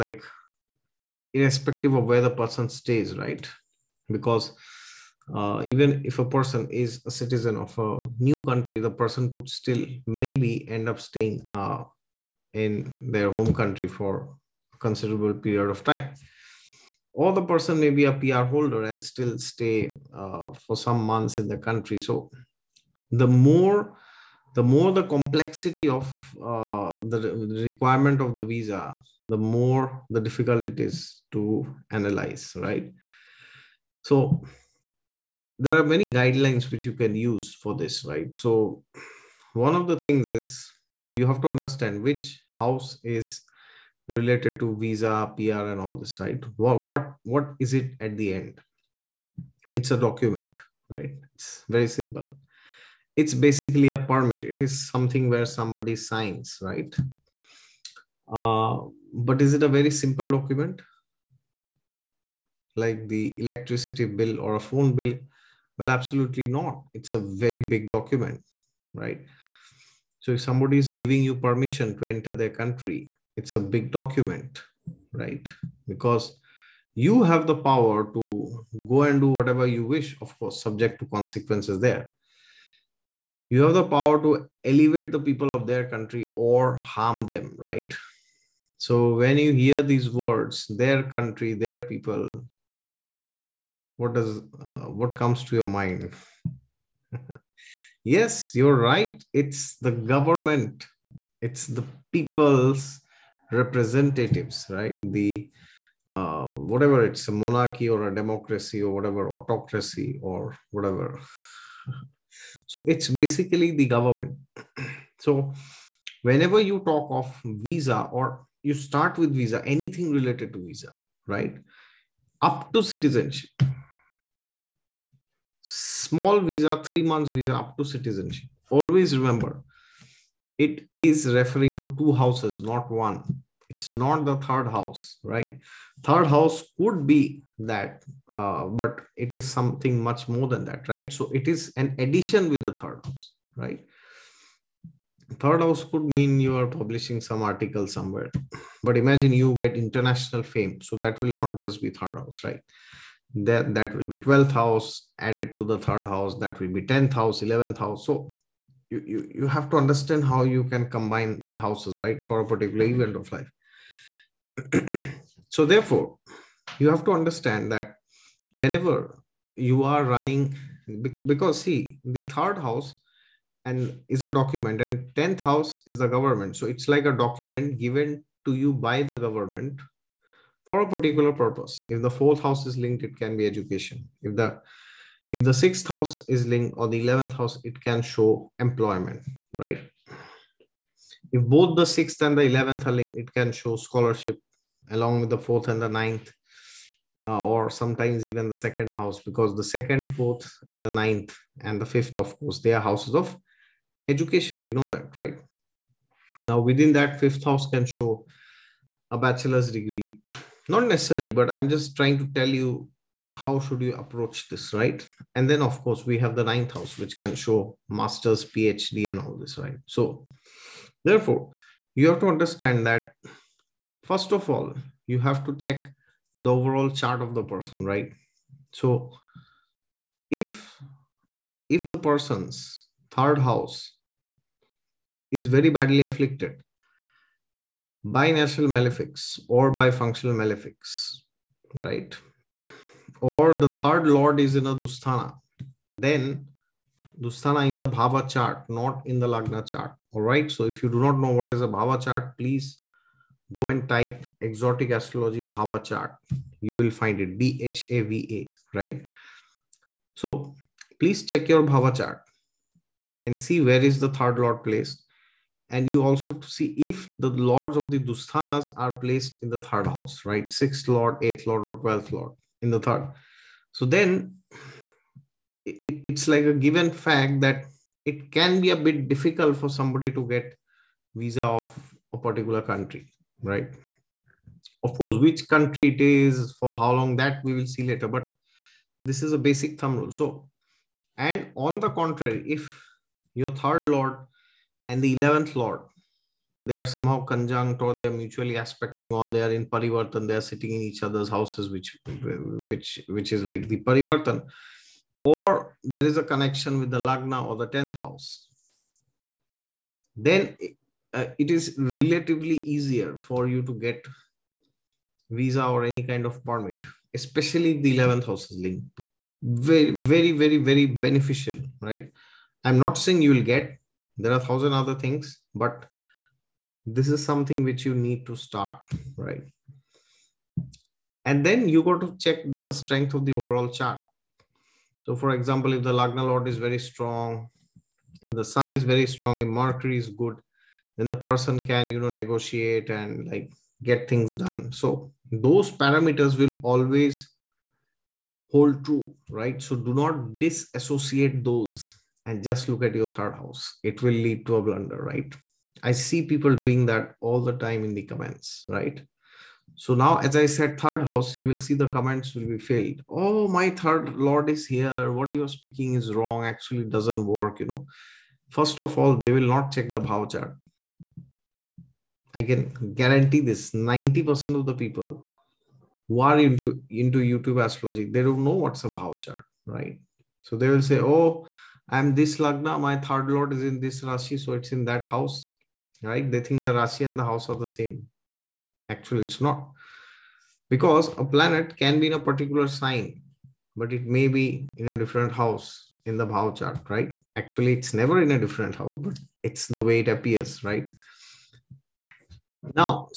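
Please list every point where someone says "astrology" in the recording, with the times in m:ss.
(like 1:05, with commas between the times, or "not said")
4:14, 6:17.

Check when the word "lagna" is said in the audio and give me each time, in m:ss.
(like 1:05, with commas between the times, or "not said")
4:09, 5:07, 5:35, 6:22.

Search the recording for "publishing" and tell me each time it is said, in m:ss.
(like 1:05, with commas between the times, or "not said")
2:26.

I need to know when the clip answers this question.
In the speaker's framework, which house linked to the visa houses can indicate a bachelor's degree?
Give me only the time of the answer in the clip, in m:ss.
3:27.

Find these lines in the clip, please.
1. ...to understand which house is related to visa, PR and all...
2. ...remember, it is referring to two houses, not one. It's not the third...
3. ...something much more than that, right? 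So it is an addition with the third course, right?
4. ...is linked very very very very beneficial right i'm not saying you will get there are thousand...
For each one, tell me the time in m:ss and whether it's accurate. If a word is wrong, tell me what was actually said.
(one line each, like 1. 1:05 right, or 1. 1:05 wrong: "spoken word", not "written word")
1. 0:41 right
2. 2:09 right
3. 2:19 wrong: "house", not "course"
4. 5:18 right.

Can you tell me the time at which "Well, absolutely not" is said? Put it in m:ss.
1:05.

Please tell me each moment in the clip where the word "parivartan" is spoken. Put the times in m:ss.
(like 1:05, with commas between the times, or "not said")
4:59, 5:03.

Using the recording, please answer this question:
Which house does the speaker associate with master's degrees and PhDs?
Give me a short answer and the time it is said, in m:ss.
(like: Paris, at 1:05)
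Ninth house, at 3:36.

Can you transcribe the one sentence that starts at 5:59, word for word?
So now, as I said, third house, you will see the comments will be filled.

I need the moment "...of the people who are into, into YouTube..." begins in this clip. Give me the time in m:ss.
6:14.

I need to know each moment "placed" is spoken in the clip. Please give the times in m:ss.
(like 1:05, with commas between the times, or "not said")
4:24, 4:28.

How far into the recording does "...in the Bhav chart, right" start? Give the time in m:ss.
6:36.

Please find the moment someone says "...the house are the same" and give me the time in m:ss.
6:27.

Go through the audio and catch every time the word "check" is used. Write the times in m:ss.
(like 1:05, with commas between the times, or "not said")
3:45, 4:21, 5:32, 6:09.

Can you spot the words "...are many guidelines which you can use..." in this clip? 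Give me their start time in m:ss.
0:35.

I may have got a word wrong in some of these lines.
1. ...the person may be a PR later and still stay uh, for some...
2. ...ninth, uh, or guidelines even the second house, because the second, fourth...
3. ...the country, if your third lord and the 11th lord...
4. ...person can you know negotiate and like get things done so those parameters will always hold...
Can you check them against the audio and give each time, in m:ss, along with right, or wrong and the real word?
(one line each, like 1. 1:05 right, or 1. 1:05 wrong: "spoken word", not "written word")
1. 0:17 wrong: "holder", not "later"
2. 3:15 wrong: "sometimes", not "guidelines"
3. 4:51 wrong: "contrary", not "country"
4. 5:41 right.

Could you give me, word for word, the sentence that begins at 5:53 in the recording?
It will lead to a blunder, right?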